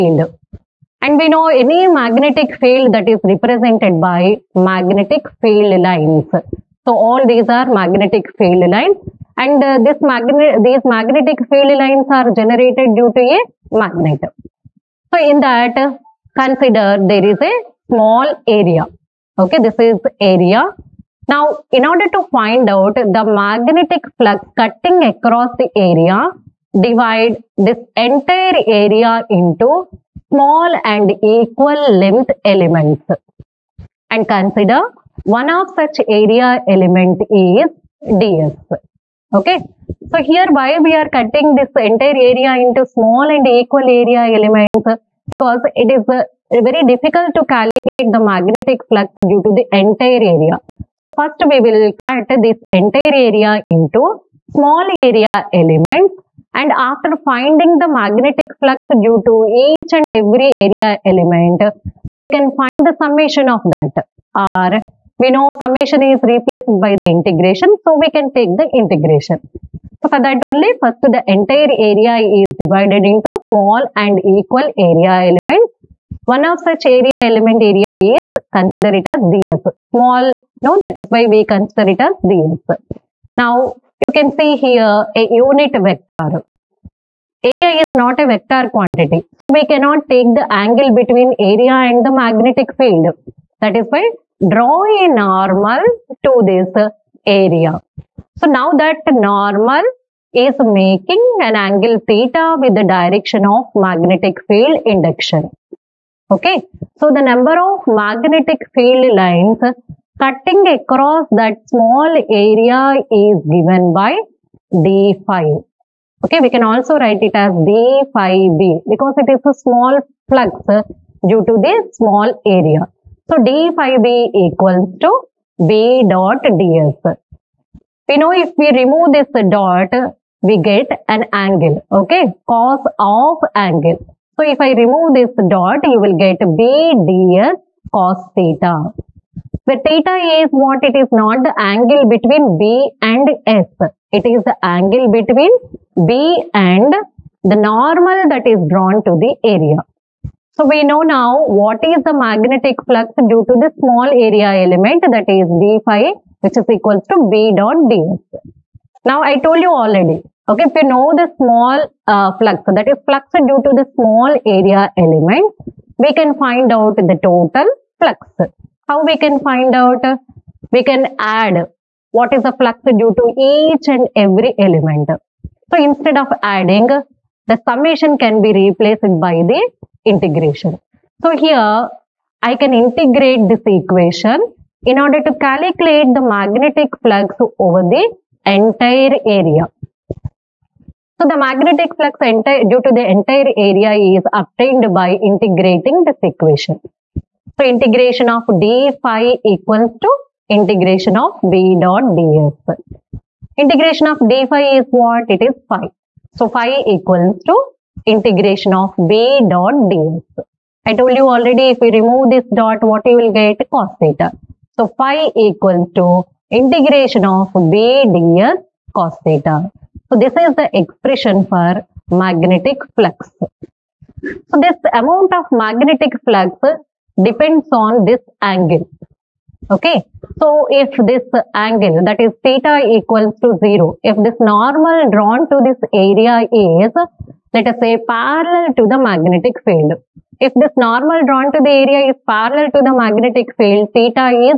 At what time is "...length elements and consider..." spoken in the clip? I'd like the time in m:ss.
0:32.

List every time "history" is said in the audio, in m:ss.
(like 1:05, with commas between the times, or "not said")
not said.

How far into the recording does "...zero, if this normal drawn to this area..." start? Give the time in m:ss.
3:53.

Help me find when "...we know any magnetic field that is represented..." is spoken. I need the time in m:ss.
0:01.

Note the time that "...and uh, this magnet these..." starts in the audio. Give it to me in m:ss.
0:09.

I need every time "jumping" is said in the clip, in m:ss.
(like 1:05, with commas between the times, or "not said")
not said.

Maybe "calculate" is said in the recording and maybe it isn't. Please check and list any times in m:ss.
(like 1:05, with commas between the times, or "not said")
0:47, 3:05.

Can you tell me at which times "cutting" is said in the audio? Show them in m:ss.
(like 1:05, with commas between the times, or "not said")
0:24, 0:41, 1:50.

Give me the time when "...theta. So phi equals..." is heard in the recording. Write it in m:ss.
3:34.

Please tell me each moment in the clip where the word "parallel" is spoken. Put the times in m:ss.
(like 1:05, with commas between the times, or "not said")
3:58, 4:02.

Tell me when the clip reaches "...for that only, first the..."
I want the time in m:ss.
1:10.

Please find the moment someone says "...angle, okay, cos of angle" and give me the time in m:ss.
2:11.